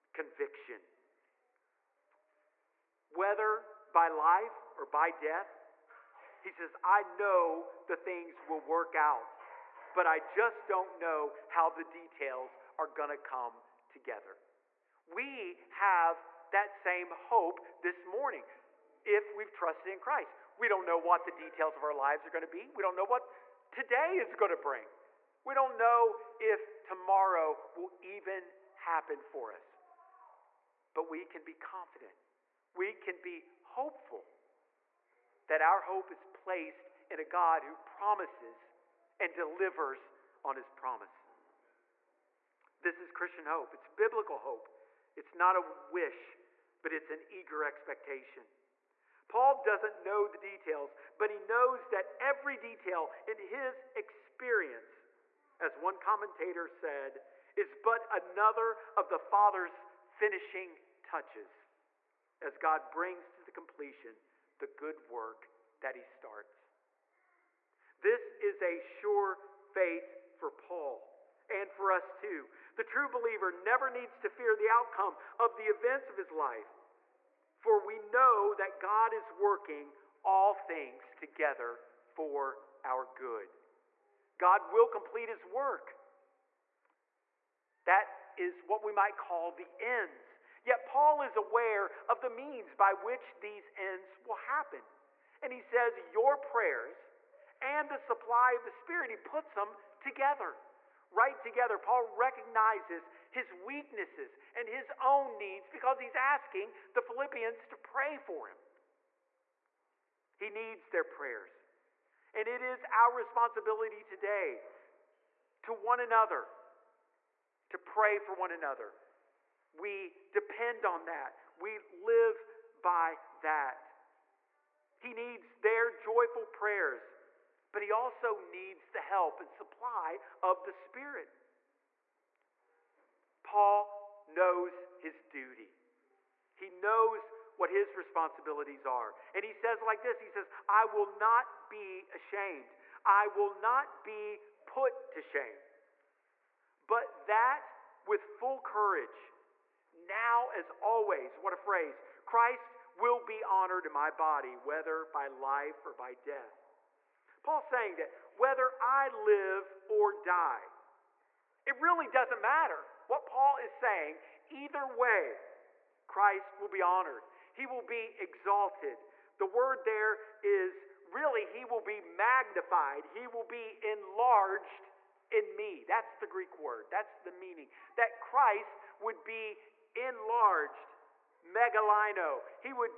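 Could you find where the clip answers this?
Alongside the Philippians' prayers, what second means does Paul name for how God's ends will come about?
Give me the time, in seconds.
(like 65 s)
97 s.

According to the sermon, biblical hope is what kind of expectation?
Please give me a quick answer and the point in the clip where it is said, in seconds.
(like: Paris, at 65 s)
eager expectation, at 47 s.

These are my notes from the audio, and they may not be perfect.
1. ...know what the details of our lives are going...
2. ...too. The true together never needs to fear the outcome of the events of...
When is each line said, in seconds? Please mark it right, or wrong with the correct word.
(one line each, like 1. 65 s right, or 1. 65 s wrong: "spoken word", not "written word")
1. 20 s right
2. 72 s wrong: "believer", not "together".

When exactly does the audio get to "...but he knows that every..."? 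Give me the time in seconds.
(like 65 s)
51 s.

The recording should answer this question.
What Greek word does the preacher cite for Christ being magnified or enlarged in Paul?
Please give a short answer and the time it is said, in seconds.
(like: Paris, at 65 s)
megalino, at 181 s.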